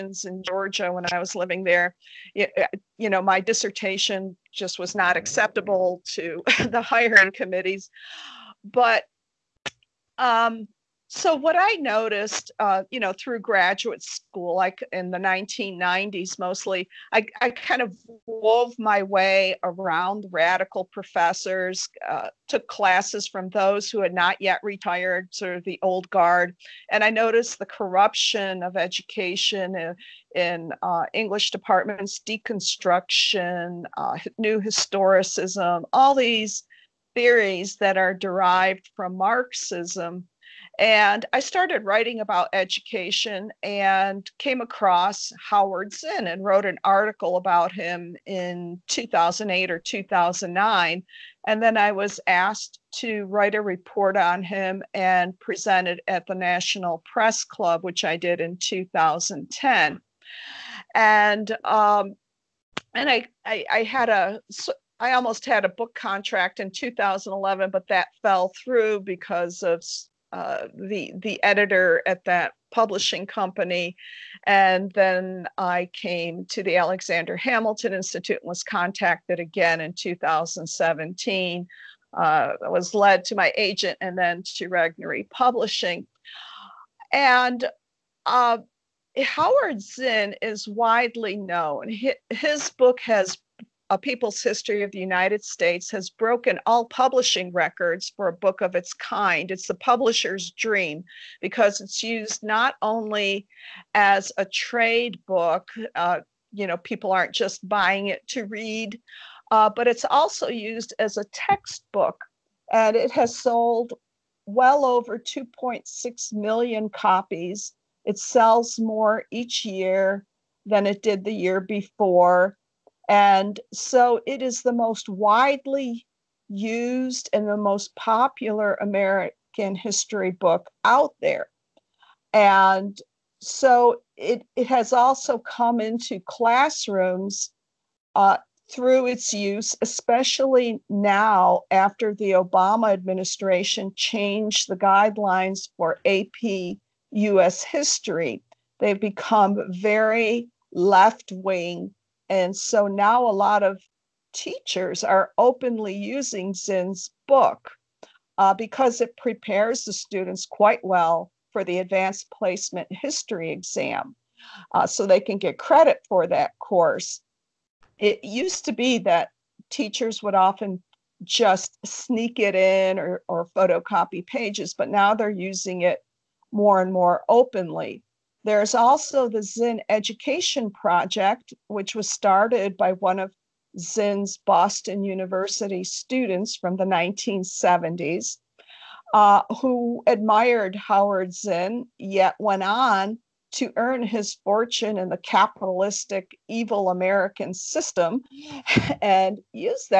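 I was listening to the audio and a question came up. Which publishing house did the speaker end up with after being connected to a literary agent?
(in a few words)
Regnery Publishing.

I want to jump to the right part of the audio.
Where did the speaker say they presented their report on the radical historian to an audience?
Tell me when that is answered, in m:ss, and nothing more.
0:56.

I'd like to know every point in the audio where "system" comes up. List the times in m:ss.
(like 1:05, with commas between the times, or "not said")
3:17.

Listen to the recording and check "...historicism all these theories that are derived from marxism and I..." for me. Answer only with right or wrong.
right.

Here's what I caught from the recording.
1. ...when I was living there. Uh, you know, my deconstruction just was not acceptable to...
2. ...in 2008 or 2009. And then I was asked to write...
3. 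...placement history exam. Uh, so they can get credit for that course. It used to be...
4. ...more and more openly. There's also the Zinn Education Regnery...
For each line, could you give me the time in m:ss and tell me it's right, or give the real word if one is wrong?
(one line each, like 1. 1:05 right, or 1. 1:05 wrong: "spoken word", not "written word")
1. 0:00 wrong: "dissertation", not "deconstruction"
2. 0:48 right
3. 2:42 right
4. 2:56 wrong: "Project", not "Regnery".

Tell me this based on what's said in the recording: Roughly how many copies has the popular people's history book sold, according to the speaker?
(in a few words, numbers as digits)
2.6 million.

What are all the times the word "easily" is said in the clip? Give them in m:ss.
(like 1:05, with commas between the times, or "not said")
not said.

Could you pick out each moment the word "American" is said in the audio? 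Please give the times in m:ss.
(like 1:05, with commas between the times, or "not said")
2:08, 3:16.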